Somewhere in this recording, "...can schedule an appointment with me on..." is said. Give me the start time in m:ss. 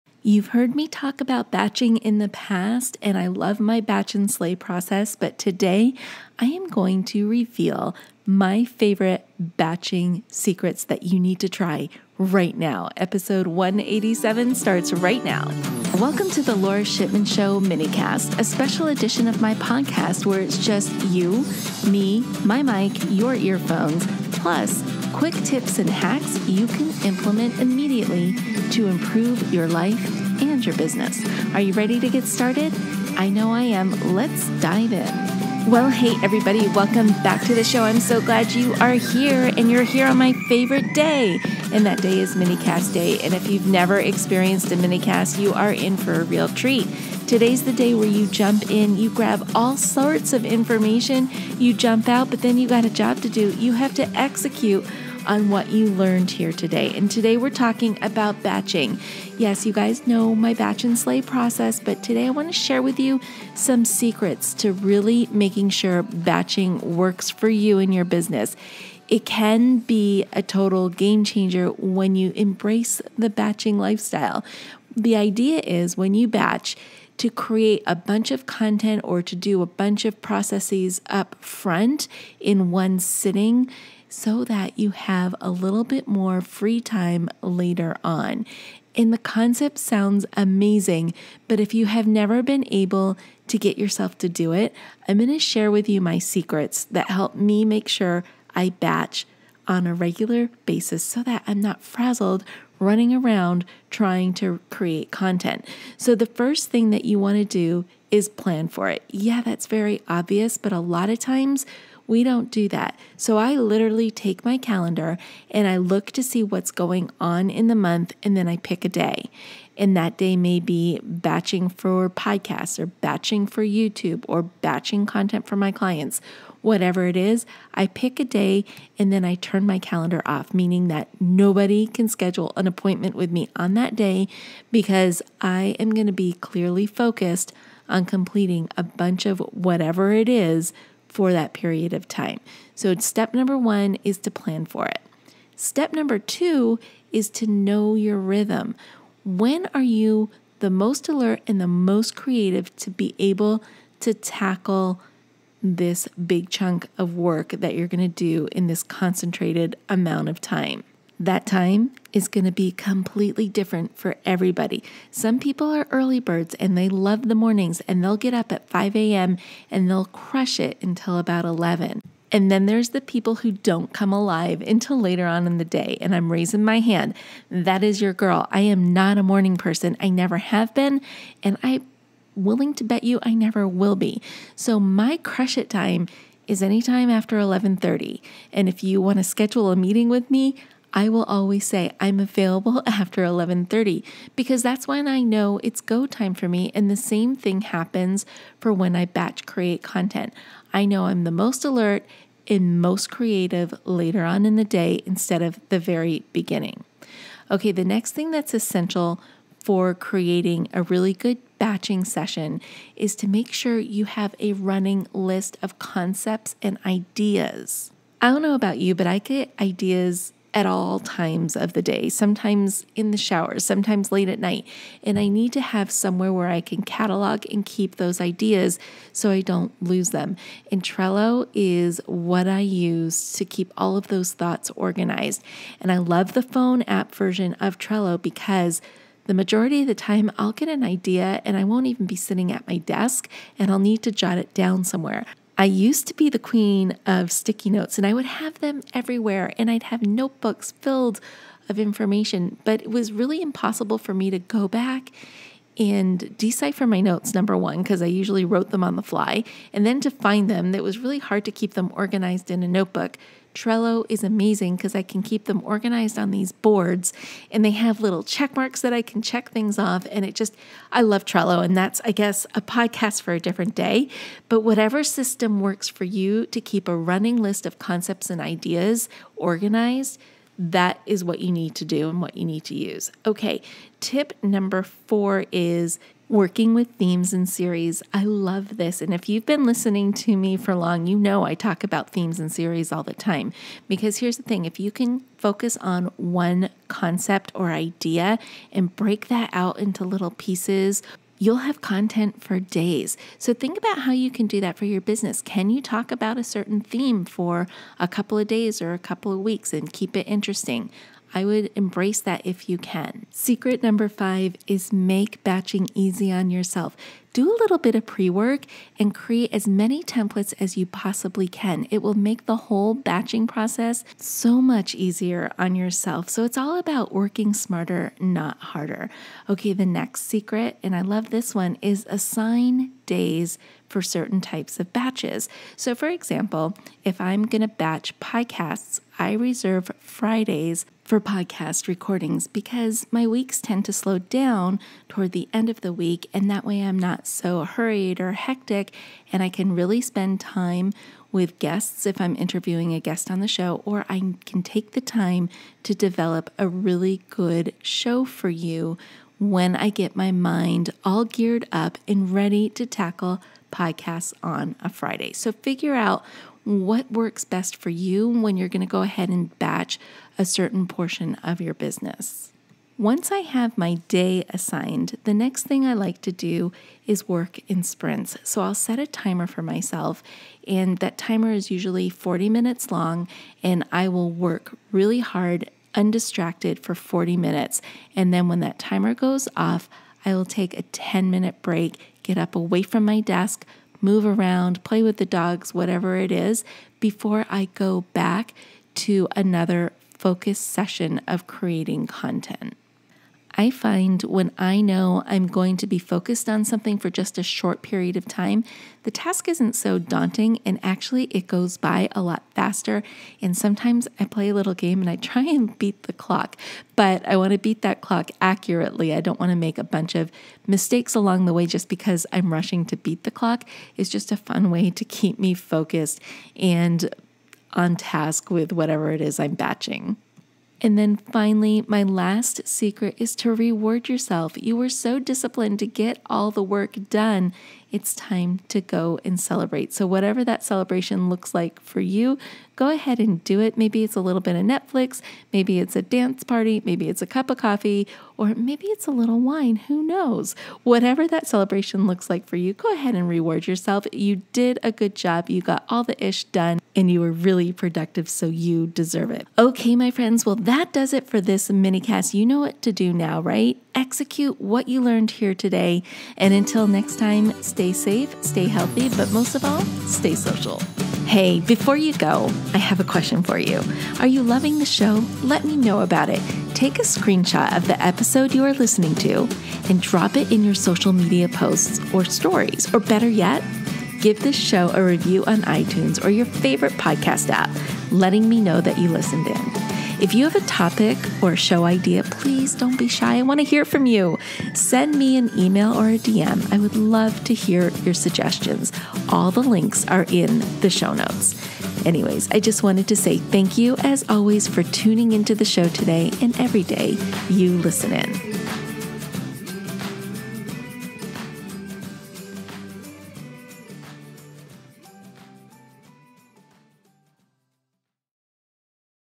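2:11.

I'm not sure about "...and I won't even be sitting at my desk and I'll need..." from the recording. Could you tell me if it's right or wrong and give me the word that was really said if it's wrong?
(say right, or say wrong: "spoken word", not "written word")
right.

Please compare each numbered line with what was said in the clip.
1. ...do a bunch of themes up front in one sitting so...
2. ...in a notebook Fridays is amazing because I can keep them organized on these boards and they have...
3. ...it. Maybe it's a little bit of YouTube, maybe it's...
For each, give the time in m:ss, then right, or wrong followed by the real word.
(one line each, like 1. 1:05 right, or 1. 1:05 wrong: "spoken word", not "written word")
1. 1:19 wrong: "processes", not "themes"
2. 4:22 wrong: "Trello", not "Fridays"
3. 7:23 wrong: "Netflix", not "YouTube".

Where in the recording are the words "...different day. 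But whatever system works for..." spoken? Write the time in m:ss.
4:33.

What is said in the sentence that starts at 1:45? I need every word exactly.
So, the first thing that you want to do is plan for it.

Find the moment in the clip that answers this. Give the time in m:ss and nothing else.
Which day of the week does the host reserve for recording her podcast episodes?
5:40.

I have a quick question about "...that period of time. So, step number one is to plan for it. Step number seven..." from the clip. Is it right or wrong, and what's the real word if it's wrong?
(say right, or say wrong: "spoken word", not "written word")
wrong: "two", not "seven".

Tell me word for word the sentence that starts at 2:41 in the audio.
that time is going to be completely different for everybody.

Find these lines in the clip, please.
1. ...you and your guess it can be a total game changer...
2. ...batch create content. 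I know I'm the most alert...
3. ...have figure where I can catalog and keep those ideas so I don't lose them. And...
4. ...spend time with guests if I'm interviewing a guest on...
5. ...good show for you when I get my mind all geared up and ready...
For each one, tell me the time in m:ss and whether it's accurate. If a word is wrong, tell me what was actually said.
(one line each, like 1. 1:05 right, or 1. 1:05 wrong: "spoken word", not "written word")
1. 1:07 wrong: "business", not "guess"
2. 3:19 right
3. 3:45 wrong: "somewhere", not "figure"
4. 5:49 right
5. 5:57 right.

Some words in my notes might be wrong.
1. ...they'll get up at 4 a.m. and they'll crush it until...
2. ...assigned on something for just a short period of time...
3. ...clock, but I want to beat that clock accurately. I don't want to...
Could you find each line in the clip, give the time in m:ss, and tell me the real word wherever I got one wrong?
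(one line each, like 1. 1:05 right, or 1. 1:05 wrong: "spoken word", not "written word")
1. 2:48 wrong: "5", not "4"
2. 6:45 wrong: "focused", not "assigned"
3. 6:56 right.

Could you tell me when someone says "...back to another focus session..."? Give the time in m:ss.
6:38.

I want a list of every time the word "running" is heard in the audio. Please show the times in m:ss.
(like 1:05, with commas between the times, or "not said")
1:42, 3:34, 4:36.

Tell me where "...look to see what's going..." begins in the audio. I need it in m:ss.
1:55.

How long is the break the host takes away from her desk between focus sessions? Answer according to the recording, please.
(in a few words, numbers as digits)
10 minutes.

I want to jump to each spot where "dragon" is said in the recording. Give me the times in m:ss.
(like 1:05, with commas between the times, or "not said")
not said.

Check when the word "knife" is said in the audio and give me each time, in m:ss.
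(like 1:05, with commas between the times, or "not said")
not said.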